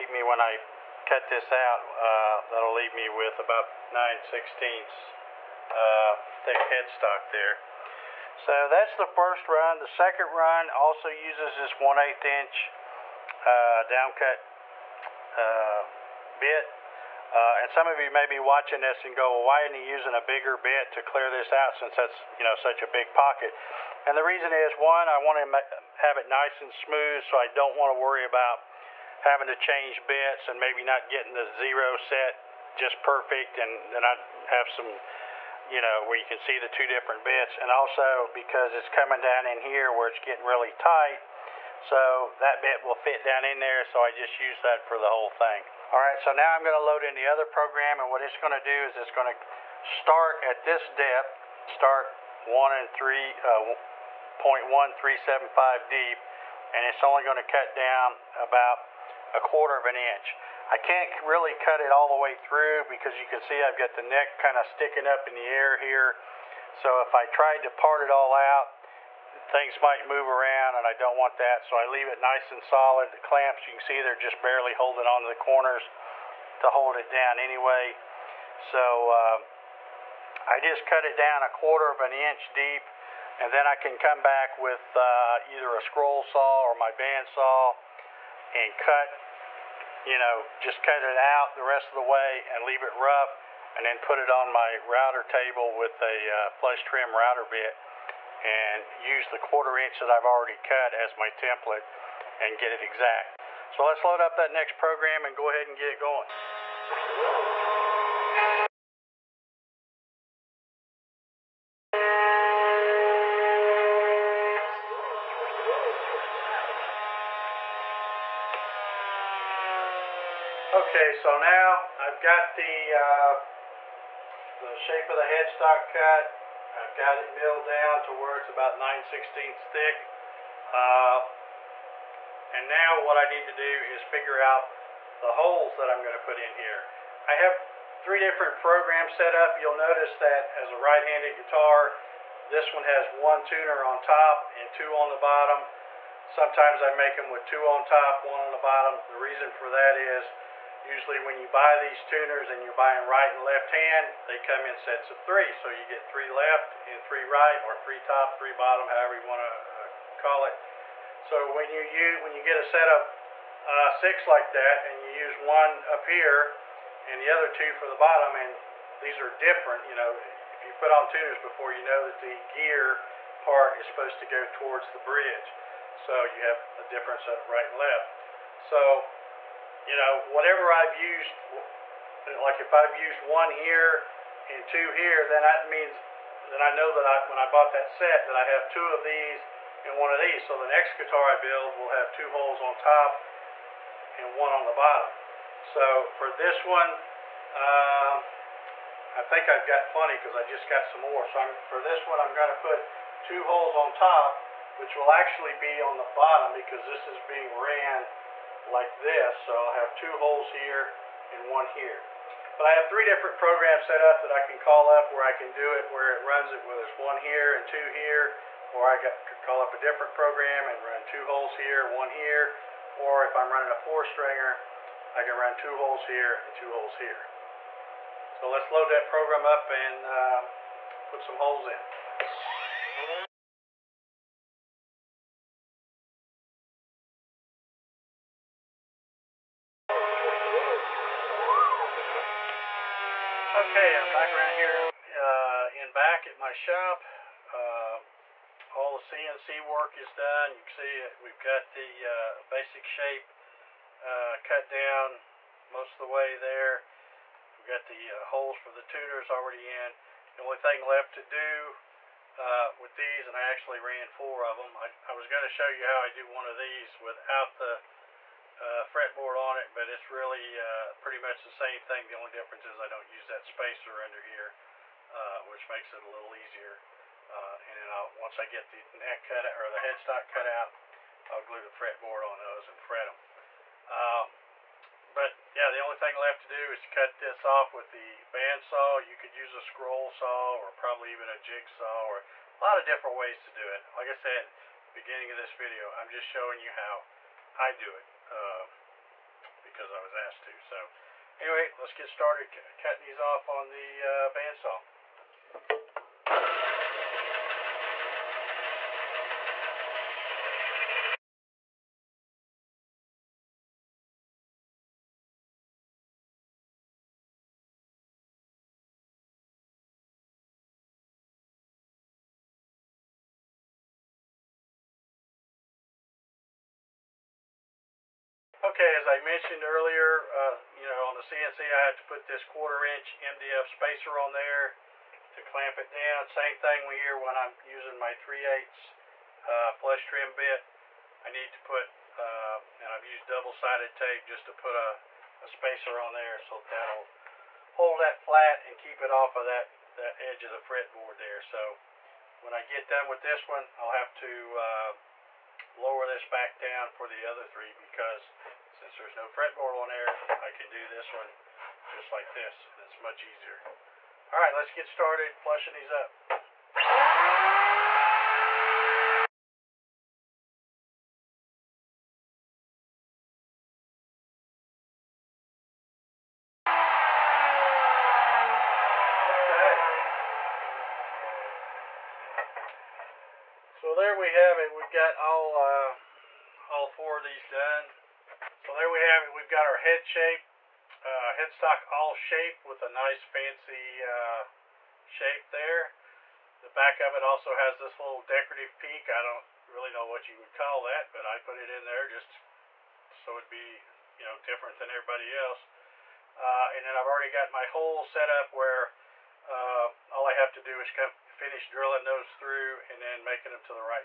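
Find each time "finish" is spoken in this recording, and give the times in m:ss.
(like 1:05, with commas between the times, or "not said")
6:51.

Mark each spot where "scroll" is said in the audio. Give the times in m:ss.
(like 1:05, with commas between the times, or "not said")
1:25, 4:49.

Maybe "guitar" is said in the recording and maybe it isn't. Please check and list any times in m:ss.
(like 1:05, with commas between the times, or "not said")
2:21, 3:10.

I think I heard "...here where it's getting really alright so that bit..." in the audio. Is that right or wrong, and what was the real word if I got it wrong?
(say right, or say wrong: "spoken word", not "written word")
wrong: "tight", not "alright".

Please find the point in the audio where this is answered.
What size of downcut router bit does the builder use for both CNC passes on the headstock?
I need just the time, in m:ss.
0:11.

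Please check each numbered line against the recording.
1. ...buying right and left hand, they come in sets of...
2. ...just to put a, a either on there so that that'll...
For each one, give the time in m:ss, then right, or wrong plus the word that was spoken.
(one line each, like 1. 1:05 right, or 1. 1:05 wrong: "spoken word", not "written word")
1. 2:32 right
2. 5:44 wrong: "spacer", not "either".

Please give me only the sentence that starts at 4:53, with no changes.
Like I said, beginning of this video, I'm just showing you how I do it.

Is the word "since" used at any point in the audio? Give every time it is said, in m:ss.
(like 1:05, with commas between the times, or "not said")
0:21, 5:58.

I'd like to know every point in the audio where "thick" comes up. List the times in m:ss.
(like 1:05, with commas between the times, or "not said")
0:06, 2:09.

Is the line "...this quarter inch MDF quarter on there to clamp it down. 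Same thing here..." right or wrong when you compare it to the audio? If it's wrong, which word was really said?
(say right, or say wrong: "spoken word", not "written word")
wrong: "spacer", not "quarter".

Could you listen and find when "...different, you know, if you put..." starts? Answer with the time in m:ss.
2:49.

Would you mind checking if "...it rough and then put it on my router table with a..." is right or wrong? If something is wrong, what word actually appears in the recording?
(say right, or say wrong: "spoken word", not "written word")
right.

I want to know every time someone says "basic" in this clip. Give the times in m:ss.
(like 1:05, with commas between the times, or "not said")
4:12.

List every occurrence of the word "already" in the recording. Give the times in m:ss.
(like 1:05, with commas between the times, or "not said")
1:40, 4:19, 6:47.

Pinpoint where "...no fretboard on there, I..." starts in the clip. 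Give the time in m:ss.
5:59.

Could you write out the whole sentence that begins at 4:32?
The only difference is I don't use that spacer under here, uh, which makes it a little easier.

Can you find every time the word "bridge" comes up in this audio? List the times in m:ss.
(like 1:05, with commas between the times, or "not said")
2:54.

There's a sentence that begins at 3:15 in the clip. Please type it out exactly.
So for this one, um, I think I've got plenty because I just got some more.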